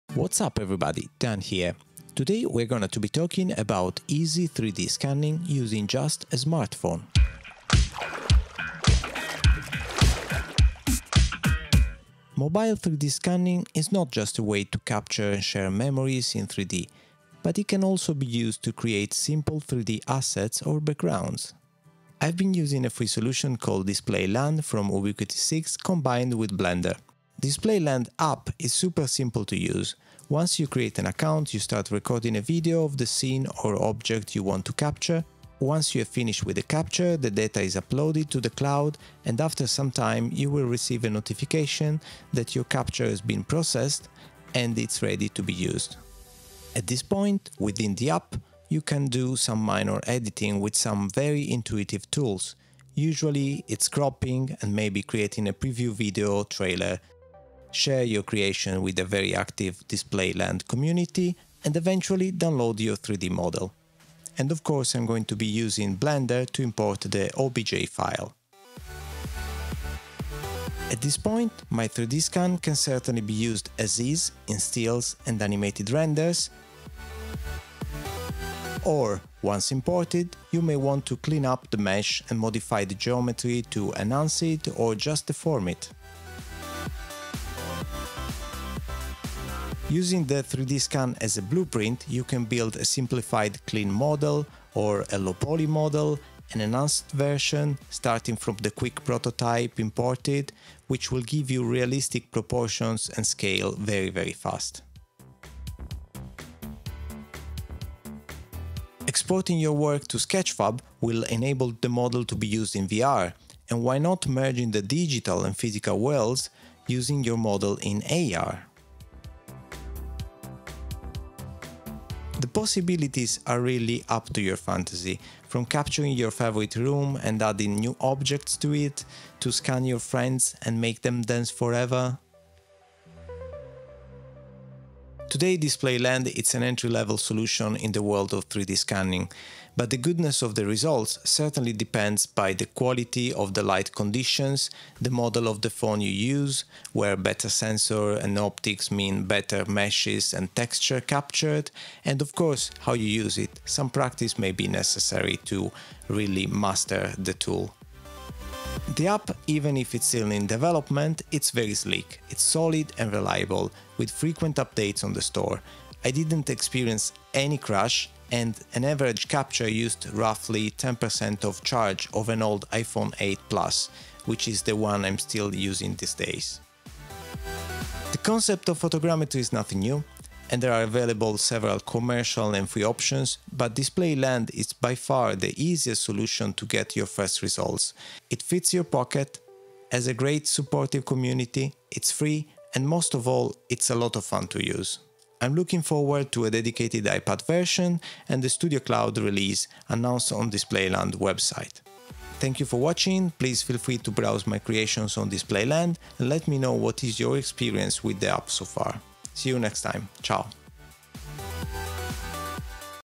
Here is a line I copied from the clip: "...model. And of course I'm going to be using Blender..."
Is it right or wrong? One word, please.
right.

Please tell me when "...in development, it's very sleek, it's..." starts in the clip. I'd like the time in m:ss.
2:40.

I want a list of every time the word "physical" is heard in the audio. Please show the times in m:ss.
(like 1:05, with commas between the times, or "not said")
1:55.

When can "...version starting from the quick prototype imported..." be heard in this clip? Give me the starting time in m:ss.
1:37.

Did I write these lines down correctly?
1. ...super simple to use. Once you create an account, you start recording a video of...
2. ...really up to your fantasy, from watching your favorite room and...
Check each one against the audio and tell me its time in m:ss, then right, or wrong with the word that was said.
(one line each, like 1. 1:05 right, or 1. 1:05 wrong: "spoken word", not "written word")
1. 0:28 right
2. 2:03 wrong: "capturing", not "watching".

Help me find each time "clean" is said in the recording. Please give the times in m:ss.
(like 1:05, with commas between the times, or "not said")
1:21, 1:33.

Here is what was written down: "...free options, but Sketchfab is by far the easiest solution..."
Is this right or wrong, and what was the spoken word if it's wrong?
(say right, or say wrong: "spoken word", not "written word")
wrong: "DisplayLand", not "Sketchfab".